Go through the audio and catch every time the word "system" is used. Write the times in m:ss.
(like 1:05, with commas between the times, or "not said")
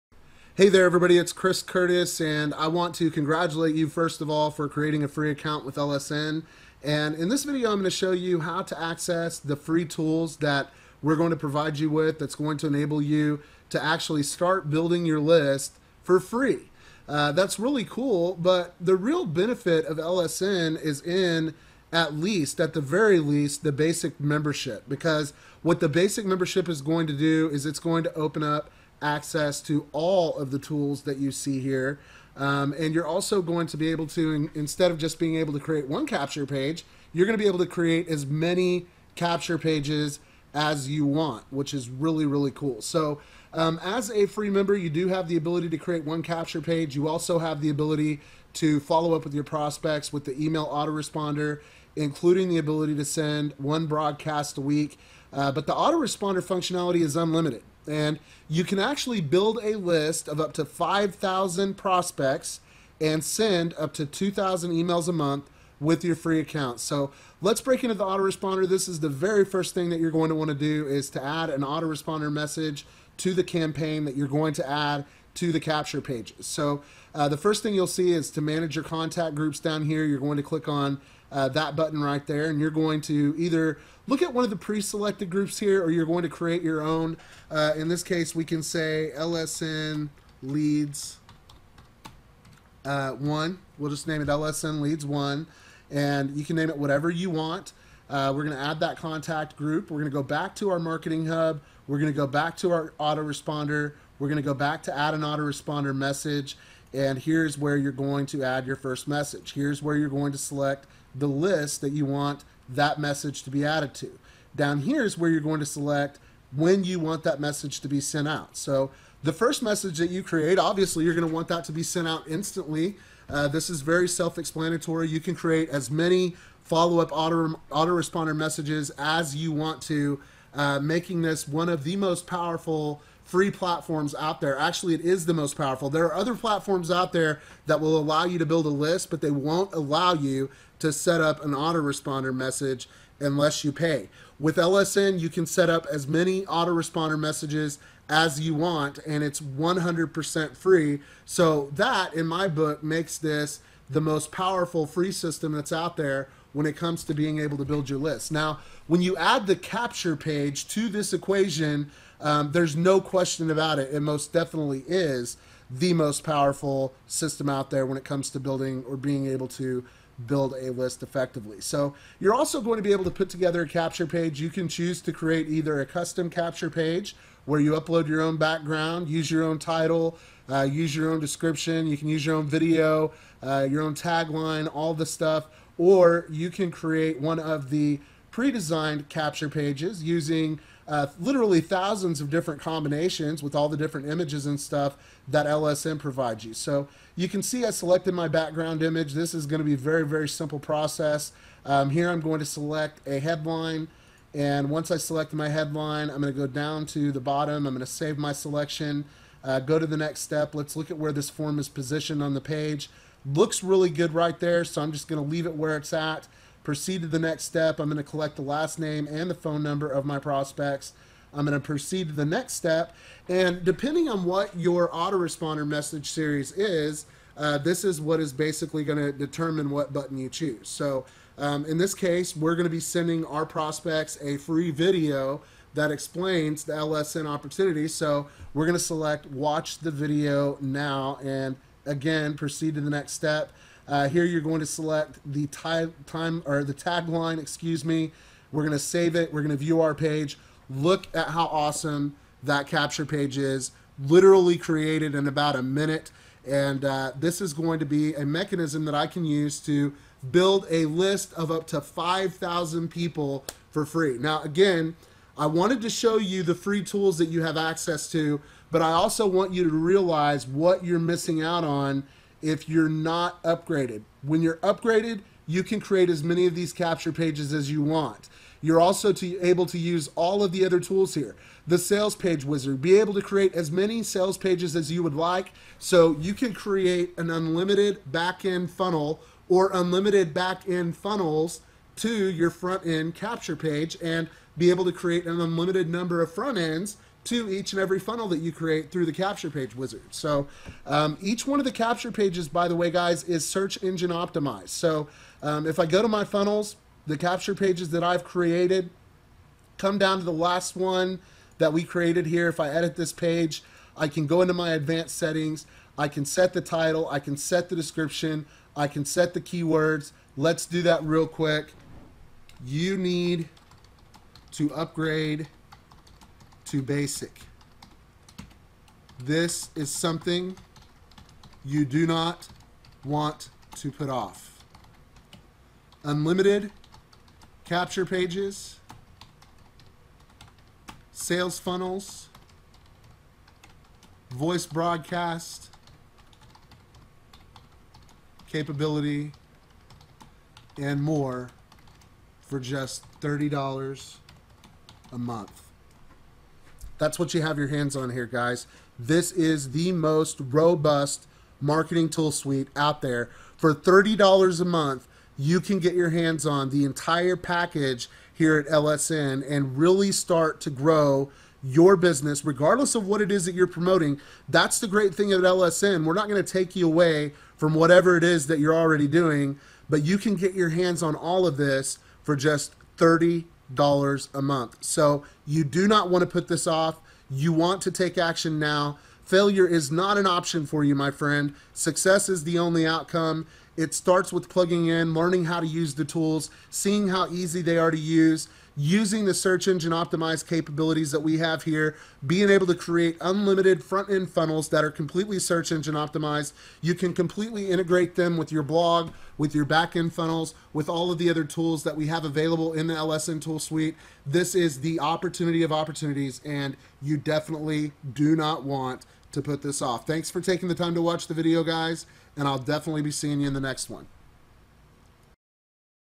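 2:35, 2:47.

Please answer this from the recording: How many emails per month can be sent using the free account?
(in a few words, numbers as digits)
2,000.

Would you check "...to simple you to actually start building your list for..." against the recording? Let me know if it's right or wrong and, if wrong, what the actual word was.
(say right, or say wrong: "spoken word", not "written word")
wrong: "enable", not "simple".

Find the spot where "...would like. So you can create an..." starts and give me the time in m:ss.
4:45.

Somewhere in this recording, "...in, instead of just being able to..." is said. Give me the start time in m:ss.
0:34.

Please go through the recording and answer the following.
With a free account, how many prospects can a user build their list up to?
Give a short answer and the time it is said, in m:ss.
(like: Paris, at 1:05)
5,000, at 1:00.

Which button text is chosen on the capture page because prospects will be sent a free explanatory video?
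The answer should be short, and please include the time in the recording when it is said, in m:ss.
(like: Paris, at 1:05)
Watch the video now, at 3:59.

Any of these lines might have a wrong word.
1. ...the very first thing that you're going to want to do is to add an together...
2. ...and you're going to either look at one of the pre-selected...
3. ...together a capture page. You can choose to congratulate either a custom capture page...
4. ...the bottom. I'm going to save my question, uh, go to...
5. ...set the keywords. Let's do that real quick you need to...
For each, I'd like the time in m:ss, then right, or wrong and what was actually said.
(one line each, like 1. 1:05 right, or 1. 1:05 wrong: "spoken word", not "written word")
1. 1:08 wrong: "autoresponder", not "together"
2. 1:22 right
3. 2:53 wrong: "create", not "congratulate"
4. 3:27 wrong: "selection", not "question"
5. 5:19 right.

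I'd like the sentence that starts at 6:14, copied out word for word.
That's the great thing at LSN.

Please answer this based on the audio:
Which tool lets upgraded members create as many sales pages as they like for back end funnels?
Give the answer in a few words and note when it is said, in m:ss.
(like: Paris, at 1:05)
sales page wizard, at 4:41.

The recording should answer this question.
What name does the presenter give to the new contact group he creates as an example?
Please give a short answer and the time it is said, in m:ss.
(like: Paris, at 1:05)
LSN leads one, at 1:34.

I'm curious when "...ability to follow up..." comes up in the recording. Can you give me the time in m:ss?
0:47.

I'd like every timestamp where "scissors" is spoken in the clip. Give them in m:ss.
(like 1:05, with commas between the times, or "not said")
not said.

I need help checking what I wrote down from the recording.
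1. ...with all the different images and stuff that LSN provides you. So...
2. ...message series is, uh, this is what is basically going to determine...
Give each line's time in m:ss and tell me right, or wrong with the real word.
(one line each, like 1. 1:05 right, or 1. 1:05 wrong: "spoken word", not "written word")
1. 3:13 right
2. 3:45 right.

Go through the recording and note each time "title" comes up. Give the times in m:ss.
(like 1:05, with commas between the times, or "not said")
2:59, 5:16.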